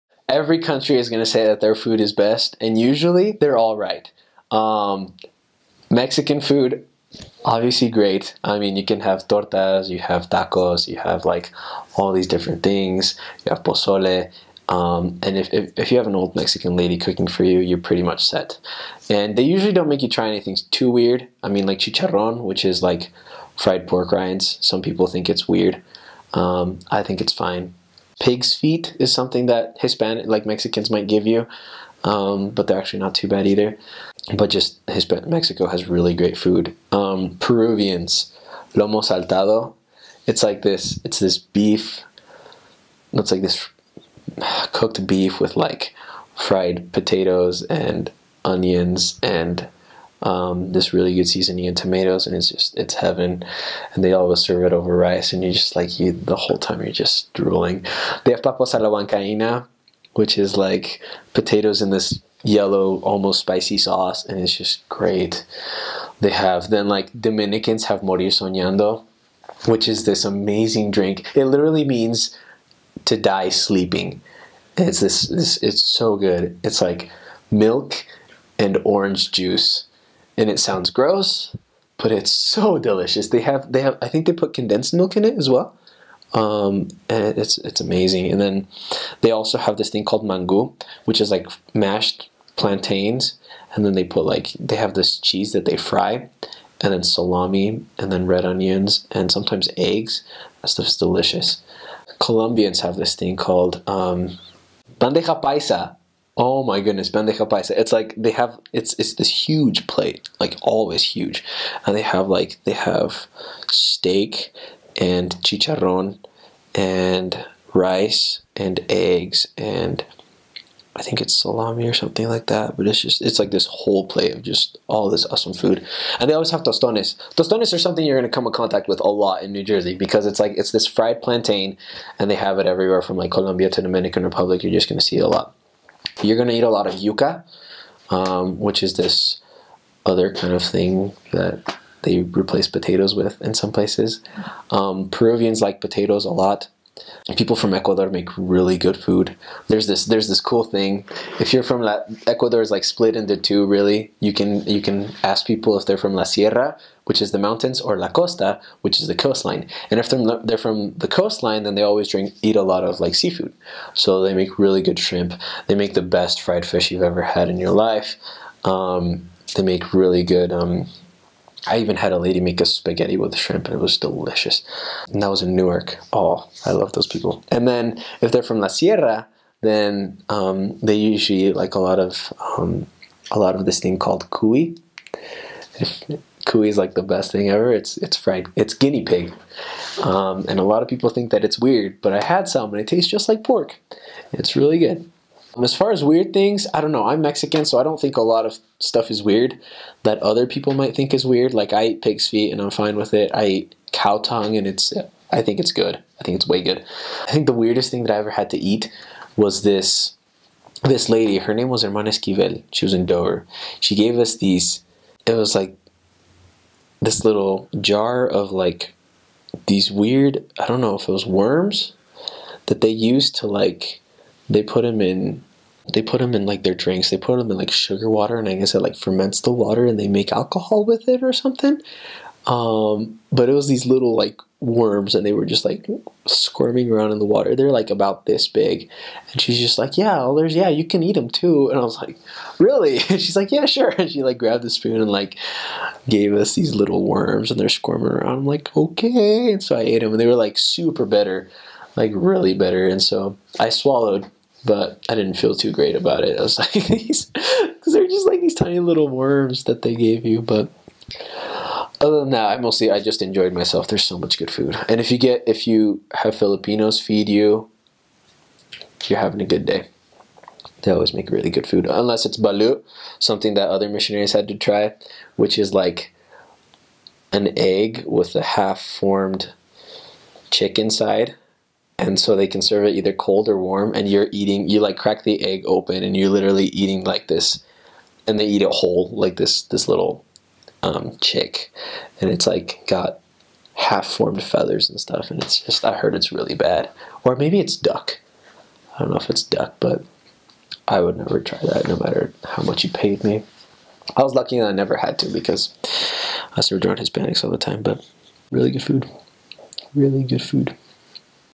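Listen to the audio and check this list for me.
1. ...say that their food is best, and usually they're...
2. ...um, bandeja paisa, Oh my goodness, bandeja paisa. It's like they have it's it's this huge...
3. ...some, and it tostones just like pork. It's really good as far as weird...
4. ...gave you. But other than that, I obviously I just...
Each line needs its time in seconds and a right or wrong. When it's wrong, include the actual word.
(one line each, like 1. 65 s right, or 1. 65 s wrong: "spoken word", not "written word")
1. 1 s right
2. 103 s right
3. 192 s wrong: "tastes", not "tostones"
4. 259 s wrong: "mostly", not "obviously".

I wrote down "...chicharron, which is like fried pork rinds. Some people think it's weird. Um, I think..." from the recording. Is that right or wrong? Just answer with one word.
right.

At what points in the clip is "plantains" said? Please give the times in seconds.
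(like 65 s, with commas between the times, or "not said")
92 s, 131 s.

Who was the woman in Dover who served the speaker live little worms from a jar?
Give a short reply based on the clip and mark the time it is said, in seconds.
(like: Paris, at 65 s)
Hermana Esquivel, at 211 s.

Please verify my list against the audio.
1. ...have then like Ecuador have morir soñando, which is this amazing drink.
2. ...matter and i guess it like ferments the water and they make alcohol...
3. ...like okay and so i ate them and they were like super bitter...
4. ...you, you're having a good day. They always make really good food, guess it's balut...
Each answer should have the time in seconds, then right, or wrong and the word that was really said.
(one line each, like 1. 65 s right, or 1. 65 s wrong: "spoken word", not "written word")
1. 66 s wrong: "Dominicans", not "Ecuador"
2. 228 s wrong: "water", not "matter"
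3. 248 s right
4. 267 s wrong: "unless", not "guess".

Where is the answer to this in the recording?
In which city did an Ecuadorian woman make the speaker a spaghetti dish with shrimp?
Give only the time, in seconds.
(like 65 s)
175 s.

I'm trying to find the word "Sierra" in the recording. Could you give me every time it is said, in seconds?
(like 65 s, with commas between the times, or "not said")
156 s, 178 s.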